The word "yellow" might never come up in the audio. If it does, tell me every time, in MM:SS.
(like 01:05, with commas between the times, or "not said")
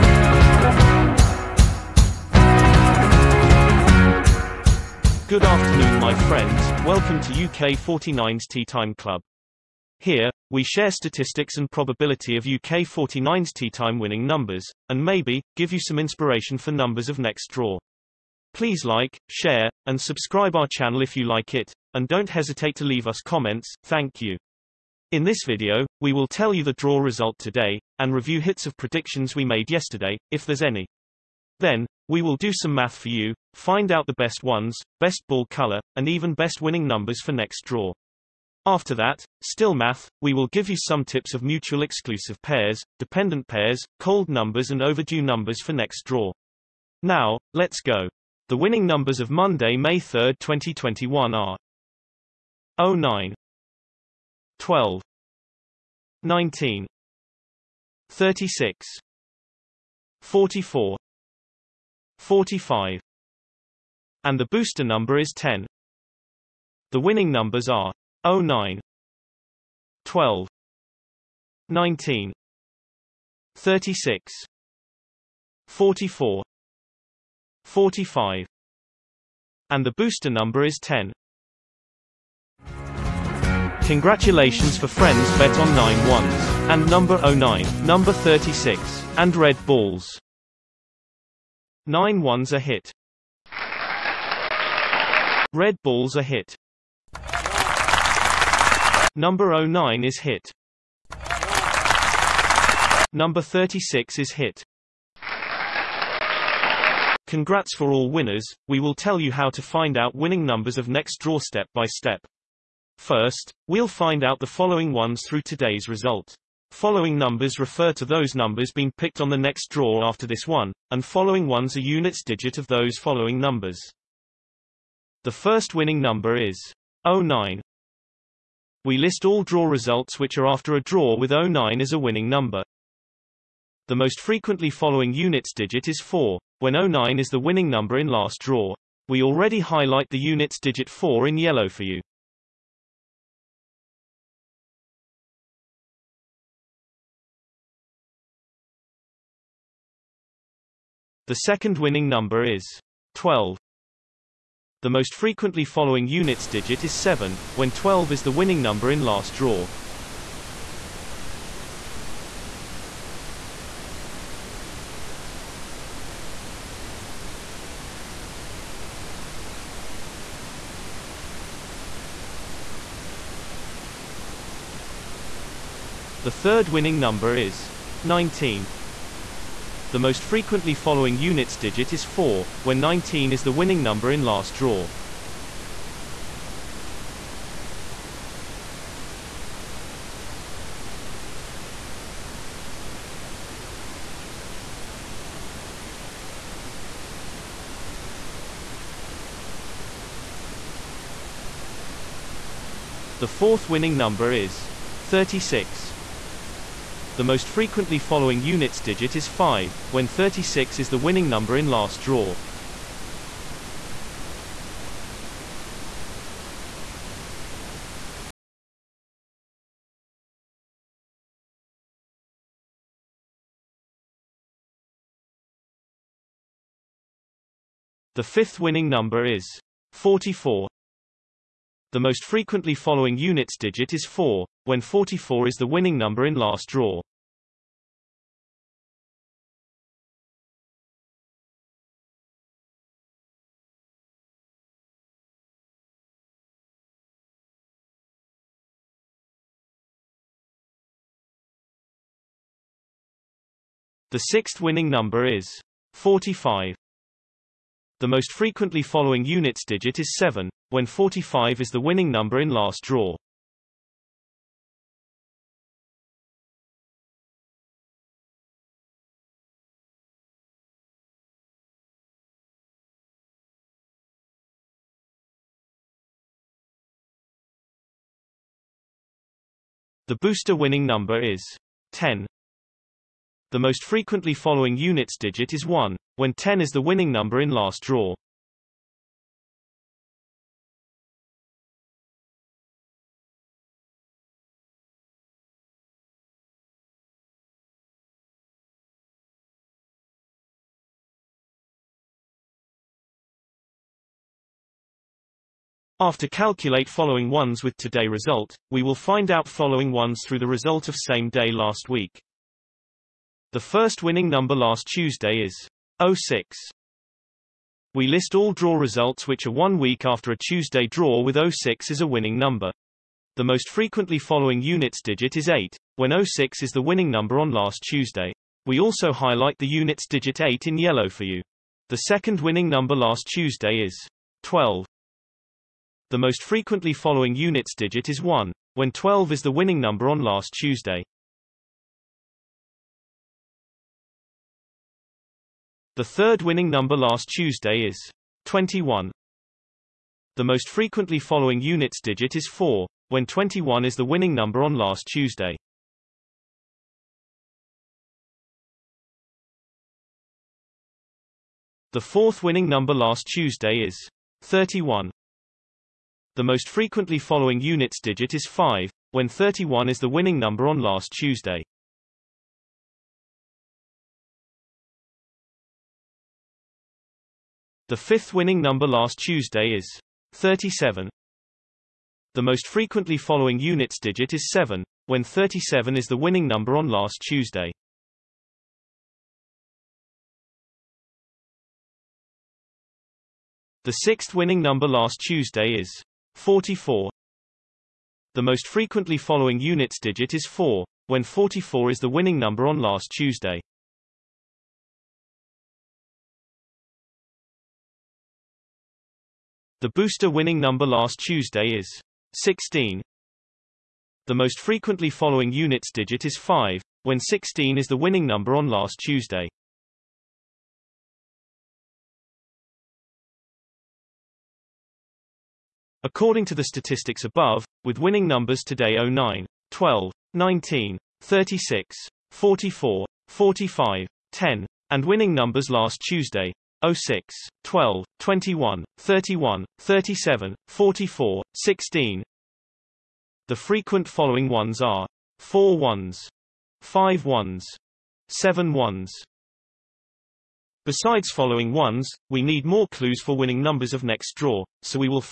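02:21, 05:30.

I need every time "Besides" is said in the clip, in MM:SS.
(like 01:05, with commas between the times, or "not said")
07:30.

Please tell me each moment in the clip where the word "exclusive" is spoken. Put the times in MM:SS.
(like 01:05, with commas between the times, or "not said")
00:41.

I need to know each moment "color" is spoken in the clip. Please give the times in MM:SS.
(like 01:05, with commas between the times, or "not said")
00:35.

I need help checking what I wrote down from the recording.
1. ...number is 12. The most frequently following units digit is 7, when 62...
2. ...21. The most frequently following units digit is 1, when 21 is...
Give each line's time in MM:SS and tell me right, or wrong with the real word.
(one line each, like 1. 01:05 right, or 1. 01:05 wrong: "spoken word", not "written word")
1. 02:32 wrong: "12", not "62"
2. 05:48 wrong: "4", not "1".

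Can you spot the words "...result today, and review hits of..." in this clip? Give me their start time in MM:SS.
00:26.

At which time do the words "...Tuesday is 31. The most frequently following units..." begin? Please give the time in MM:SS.
06:03.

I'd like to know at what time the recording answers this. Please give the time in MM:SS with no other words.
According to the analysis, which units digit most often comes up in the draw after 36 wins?
03:27.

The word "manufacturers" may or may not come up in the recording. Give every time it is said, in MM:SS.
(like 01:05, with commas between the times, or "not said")
not said.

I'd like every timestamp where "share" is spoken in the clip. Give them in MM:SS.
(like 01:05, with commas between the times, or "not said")
00:10, 00:19.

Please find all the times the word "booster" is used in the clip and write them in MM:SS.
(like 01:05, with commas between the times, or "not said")
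01:04, 01:19, 04:40, 06:49.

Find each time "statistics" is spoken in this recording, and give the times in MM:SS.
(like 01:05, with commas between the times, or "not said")
00:10, 07:06.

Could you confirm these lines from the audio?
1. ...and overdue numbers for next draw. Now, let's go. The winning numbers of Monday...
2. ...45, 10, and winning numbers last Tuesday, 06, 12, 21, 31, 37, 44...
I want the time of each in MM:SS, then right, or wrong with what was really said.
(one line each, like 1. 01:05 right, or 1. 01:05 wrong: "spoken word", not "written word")
1. 00:44 right
2. 07:13 right.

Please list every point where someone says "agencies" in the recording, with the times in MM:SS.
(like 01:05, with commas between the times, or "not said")
not said.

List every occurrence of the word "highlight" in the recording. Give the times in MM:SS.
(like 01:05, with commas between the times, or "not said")
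02:19, 05:29.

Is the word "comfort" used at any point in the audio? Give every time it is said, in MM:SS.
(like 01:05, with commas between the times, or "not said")
not said.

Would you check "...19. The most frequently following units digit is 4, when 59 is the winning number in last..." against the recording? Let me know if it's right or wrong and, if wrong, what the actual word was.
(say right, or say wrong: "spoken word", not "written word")
wrong: "19", not "59".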